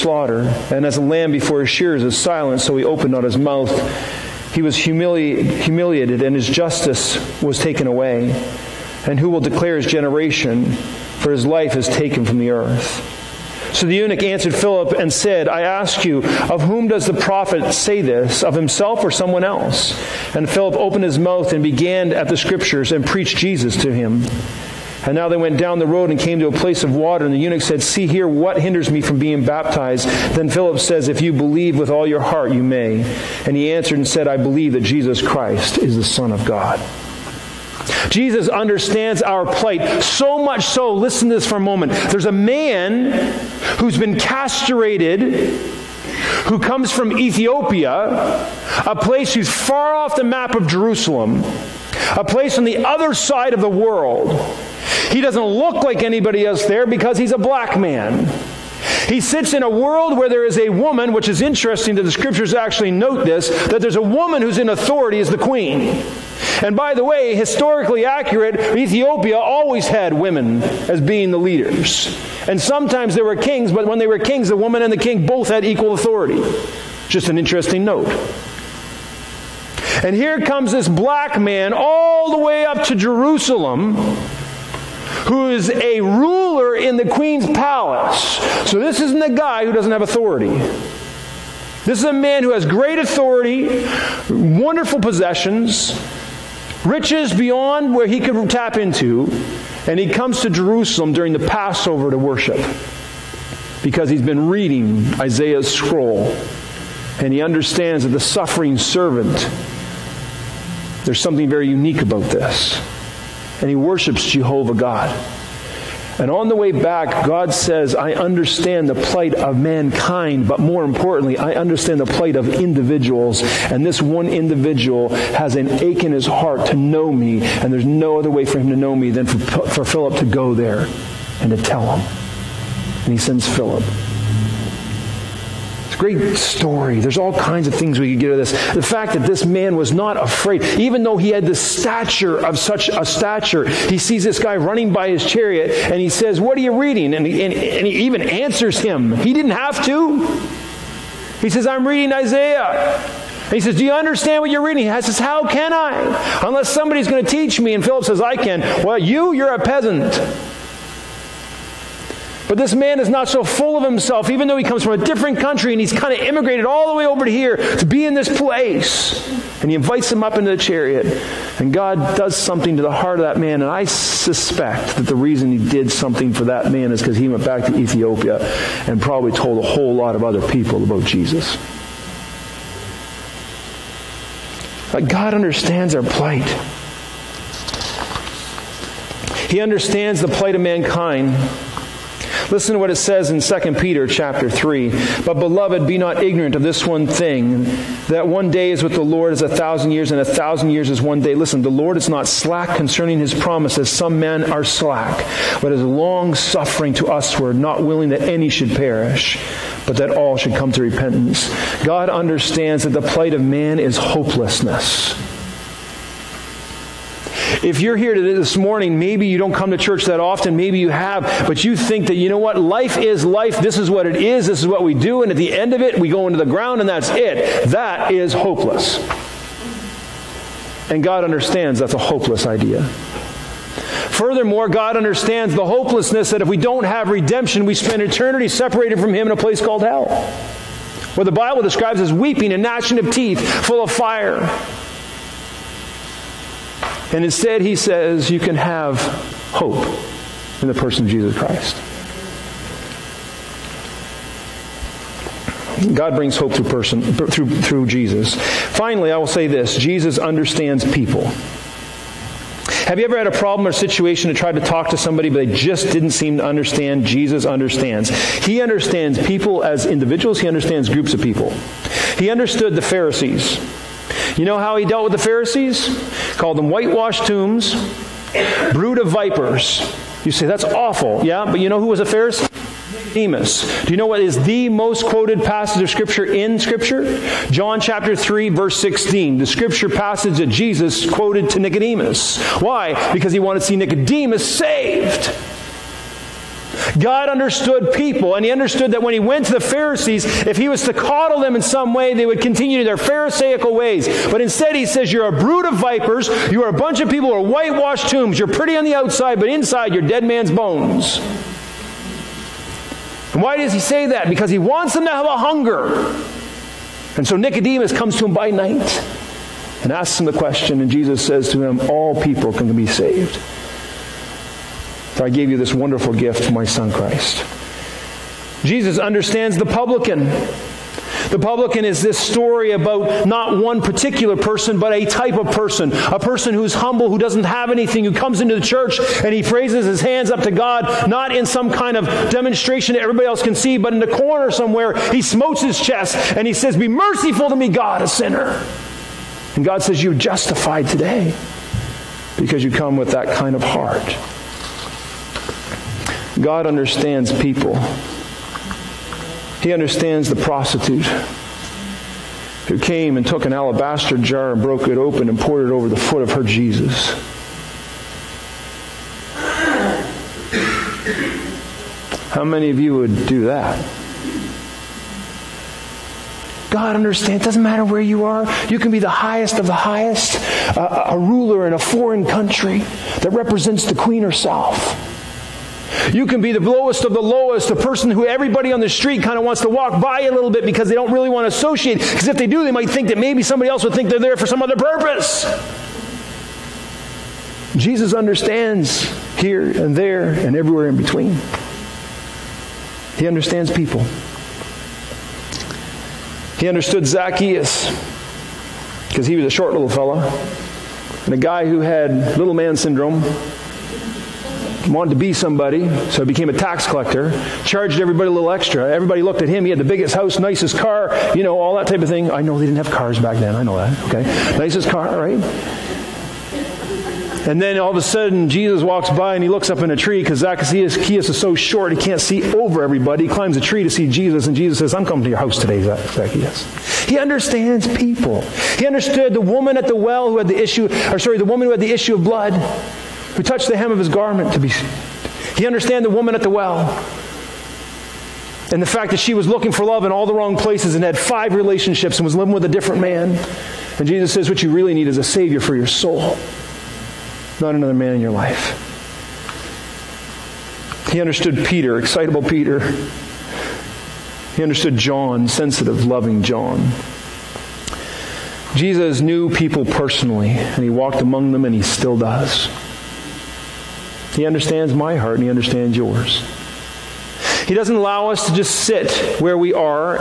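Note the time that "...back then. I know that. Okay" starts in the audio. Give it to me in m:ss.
7:03.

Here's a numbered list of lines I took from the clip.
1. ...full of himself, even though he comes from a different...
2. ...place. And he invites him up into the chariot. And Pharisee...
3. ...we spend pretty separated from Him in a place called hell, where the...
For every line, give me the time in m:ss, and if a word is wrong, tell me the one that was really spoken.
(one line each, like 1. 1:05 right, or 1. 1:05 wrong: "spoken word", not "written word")
1. 2:43 right
2. 2:48 wrong: "God", not "Pharisee"
3. 3:57 wrong: "eternity", not "pretty".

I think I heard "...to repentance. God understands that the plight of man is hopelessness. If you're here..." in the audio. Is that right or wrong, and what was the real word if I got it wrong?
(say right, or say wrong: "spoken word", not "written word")
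right.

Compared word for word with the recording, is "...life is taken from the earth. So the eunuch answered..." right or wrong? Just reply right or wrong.
right.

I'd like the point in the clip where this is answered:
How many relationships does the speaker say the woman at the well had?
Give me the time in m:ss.
7:31.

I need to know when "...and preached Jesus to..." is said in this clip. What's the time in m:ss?
0:22.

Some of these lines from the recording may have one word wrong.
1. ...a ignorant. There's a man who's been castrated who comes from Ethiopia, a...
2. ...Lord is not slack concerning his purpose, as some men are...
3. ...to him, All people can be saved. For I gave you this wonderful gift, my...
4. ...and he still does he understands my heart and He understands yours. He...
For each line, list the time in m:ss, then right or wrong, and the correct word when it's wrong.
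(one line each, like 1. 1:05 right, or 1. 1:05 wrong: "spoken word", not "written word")
1. 0:41 wrong: "moment", not "ignorant"
2. 3:21 wrong: "promise", not "purpose"
3. 5:21 right
4. 7:51 right.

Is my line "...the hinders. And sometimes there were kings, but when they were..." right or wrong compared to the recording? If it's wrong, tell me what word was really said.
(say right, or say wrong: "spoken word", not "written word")
wrong: "leaders", not "hinders".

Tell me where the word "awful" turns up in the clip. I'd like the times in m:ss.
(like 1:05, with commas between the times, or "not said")
4:40.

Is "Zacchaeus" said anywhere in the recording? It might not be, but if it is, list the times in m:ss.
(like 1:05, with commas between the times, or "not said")
6:47, 7:10, 7:15.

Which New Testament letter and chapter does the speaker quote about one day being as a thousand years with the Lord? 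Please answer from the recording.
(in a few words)
2 Peter chapter 3.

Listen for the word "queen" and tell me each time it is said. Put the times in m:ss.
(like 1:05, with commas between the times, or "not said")
1:05, 1:27, 6:23.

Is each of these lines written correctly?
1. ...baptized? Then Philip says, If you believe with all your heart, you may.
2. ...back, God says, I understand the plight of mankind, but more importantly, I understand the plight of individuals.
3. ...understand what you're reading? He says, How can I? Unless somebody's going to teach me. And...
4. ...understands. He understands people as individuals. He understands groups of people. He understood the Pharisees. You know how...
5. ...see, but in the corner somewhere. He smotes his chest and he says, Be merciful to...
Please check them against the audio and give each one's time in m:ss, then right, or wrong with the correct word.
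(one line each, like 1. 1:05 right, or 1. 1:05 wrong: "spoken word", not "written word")
1. 0:29 right
2. 1:56 right
3. 2:33 right
4. 4:27 right
5. 5:43 right.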